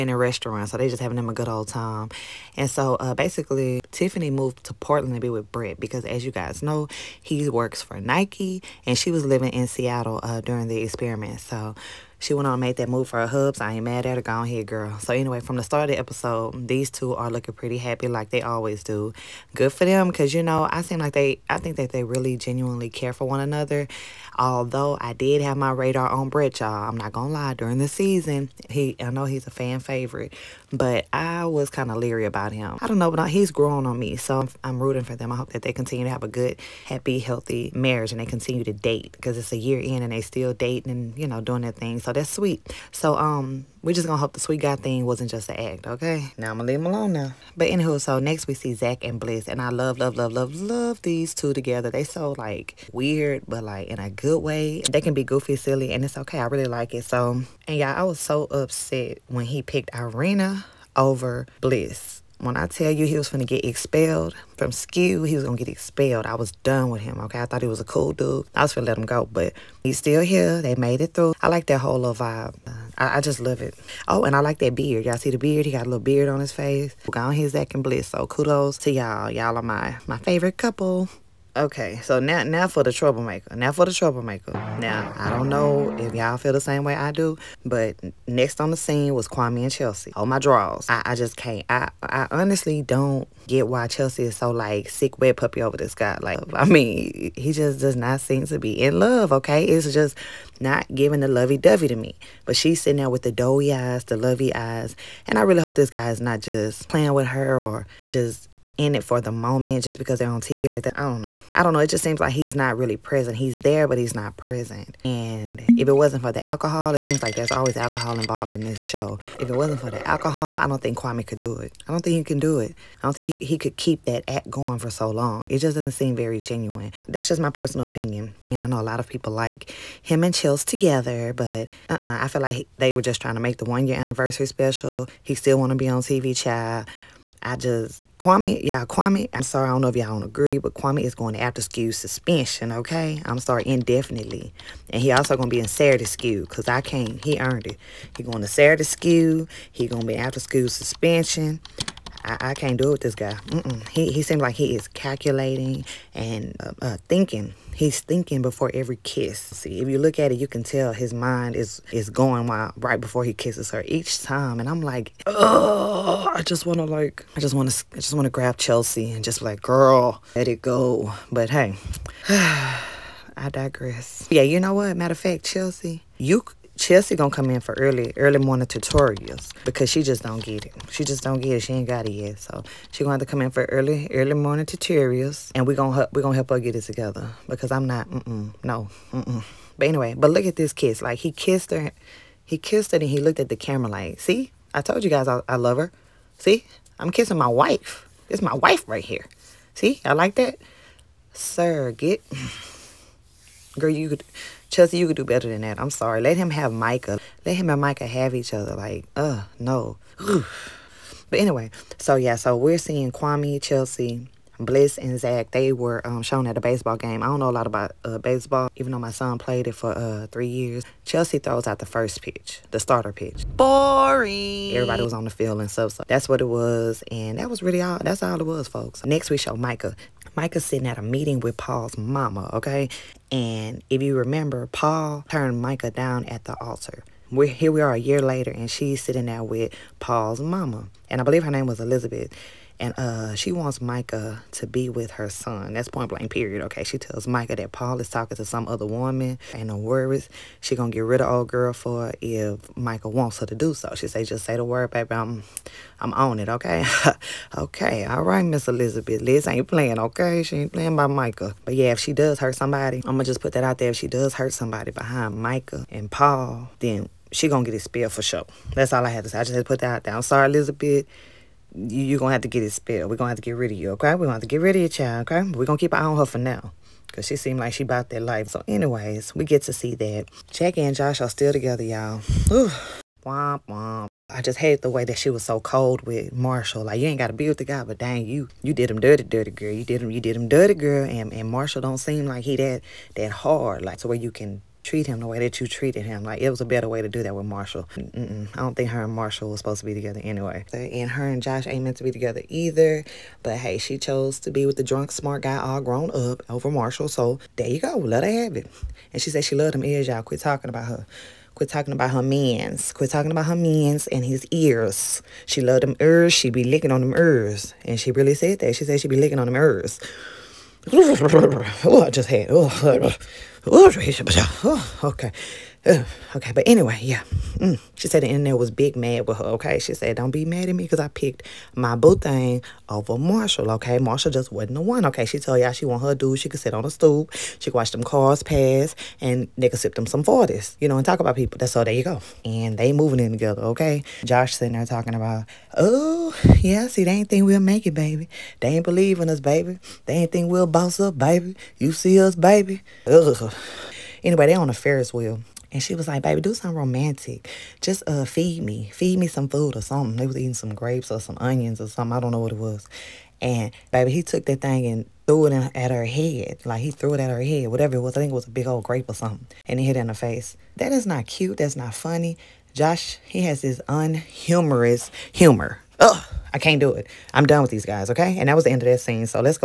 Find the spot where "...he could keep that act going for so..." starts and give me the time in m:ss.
2:03.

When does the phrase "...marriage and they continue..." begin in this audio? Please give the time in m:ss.
0:37.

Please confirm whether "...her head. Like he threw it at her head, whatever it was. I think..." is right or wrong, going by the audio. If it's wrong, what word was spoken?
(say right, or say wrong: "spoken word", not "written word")
right.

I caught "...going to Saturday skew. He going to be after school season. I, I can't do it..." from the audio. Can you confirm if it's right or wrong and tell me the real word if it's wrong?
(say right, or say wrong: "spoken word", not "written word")
wrong: "suspension", not "season".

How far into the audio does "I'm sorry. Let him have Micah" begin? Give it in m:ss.
3:25.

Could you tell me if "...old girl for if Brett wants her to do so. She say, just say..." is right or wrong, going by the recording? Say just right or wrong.
wrong.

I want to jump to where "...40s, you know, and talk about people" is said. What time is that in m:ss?
5:40.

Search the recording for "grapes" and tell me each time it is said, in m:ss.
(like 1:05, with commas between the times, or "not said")
6:00, 6:08.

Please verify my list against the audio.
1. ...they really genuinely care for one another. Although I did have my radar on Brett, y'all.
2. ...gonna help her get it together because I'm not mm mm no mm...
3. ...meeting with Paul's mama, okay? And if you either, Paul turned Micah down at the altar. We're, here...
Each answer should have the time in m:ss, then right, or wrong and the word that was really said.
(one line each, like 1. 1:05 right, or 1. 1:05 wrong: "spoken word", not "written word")
1. 0:21 right
2. 3:06 right
3. 3:51 wrong: "remember", not "either".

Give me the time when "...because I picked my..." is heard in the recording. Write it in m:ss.
5:30.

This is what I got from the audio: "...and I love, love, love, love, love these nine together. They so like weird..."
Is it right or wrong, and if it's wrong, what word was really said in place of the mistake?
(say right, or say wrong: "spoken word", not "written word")
wrong: "two", not "nine".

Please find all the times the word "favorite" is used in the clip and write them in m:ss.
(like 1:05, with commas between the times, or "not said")
0:29, 1:20.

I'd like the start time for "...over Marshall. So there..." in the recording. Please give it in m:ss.
5:06.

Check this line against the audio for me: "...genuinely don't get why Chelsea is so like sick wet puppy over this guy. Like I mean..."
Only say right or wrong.
wrong.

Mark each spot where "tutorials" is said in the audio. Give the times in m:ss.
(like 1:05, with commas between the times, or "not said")
2:58, 3:04.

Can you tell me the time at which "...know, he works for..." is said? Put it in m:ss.
0:06.